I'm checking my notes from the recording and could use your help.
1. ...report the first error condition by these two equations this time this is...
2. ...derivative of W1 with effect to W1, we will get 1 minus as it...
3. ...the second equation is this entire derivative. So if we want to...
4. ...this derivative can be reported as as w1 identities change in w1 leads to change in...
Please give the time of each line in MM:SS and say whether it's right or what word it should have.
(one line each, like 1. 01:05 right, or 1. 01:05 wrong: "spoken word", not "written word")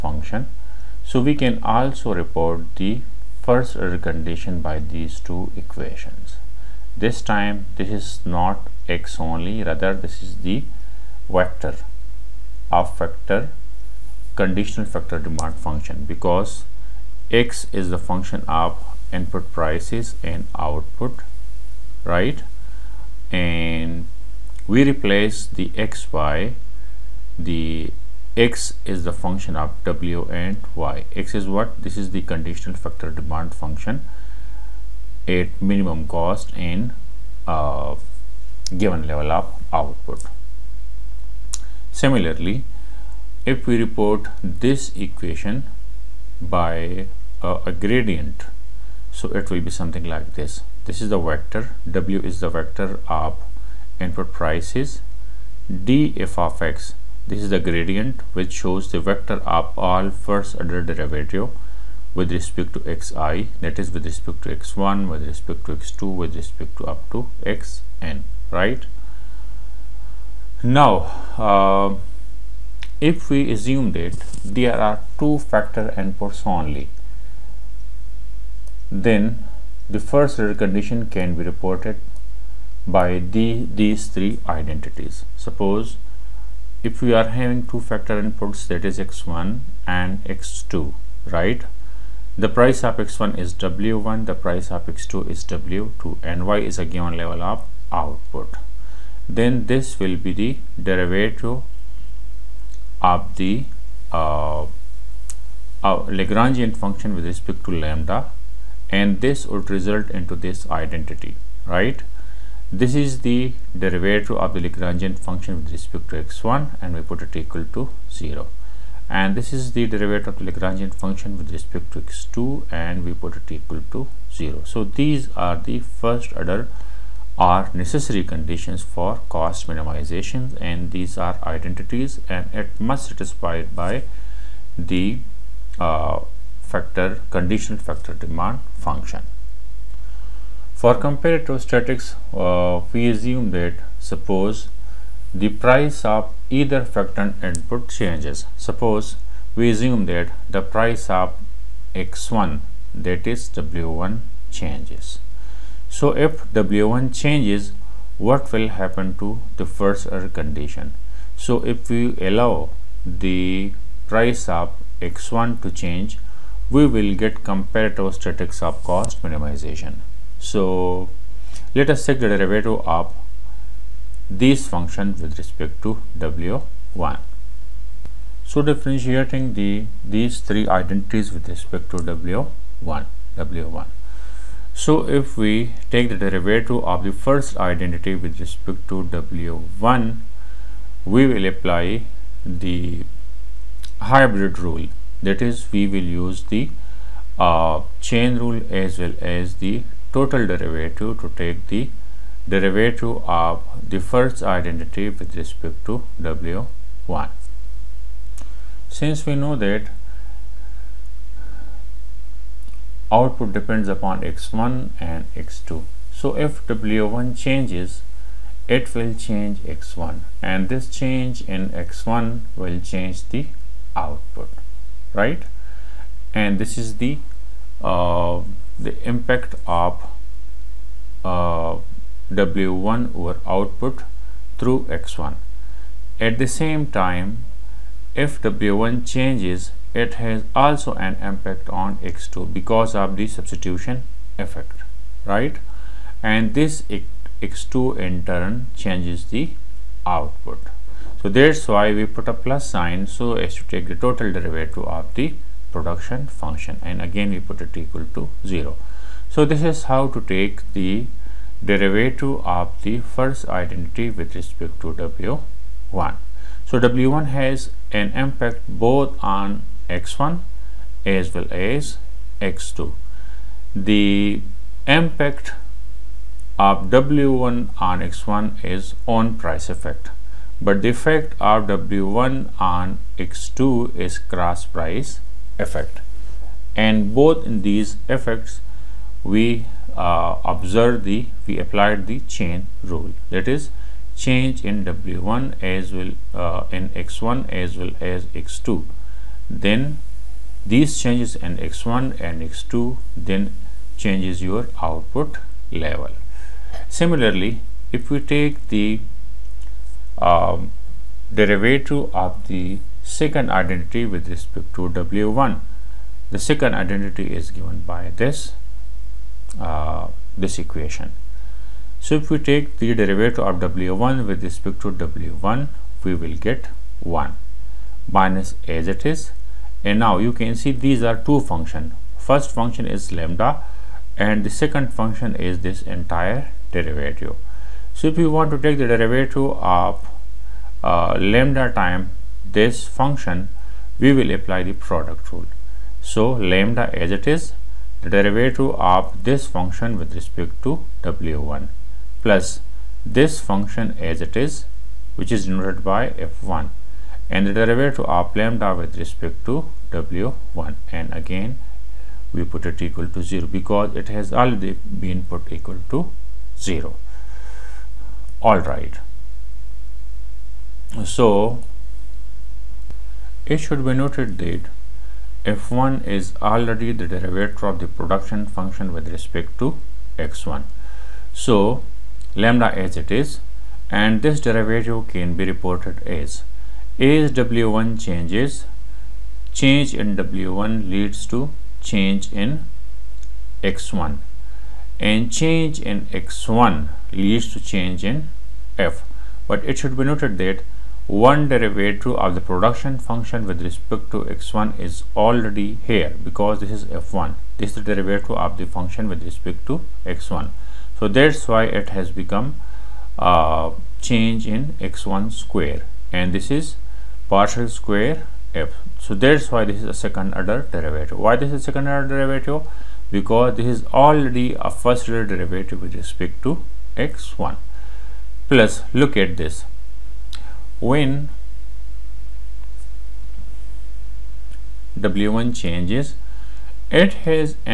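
1. 00:02 right
2. 05:22 wrong: "respect", not "effect"
3. 05:34 wrong: "function", not "equation"
4. 06:24 wrong: "changes", not "identities".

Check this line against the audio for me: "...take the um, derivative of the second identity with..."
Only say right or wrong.
right.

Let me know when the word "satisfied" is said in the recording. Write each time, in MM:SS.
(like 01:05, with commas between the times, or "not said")
02:13.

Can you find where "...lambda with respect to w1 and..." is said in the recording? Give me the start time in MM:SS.
05:58.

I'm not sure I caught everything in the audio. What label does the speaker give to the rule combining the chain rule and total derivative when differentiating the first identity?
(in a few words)
Hybrid rule.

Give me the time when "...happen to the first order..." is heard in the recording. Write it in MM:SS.
02:38.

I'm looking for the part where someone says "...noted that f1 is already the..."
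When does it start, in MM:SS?
06:13.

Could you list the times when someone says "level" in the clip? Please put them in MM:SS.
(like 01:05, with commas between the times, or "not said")
00:39, 01:37, 05:05.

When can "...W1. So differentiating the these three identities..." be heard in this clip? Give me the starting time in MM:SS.
02:56.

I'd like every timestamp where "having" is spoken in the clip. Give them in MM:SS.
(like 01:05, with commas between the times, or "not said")
01:27.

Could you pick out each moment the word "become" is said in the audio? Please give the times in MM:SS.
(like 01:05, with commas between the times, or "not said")
06:52.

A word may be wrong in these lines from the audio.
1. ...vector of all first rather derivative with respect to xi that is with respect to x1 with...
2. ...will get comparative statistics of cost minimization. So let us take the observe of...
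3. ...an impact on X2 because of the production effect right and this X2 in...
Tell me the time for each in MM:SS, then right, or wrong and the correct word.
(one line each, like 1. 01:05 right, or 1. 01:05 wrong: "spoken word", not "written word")
1. 00:59 wrong: "order", not "rather"
2. 02:46 wrong: "derivative", not "observe"
3. 04:00 wrong: "substitution", not "production".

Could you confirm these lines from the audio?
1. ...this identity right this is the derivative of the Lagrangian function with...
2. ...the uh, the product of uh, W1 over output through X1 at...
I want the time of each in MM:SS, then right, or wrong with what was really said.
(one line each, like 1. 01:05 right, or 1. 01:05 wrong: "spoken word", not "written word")
1. 01:50 right
2. 03:46 wrong: "impact", not "product".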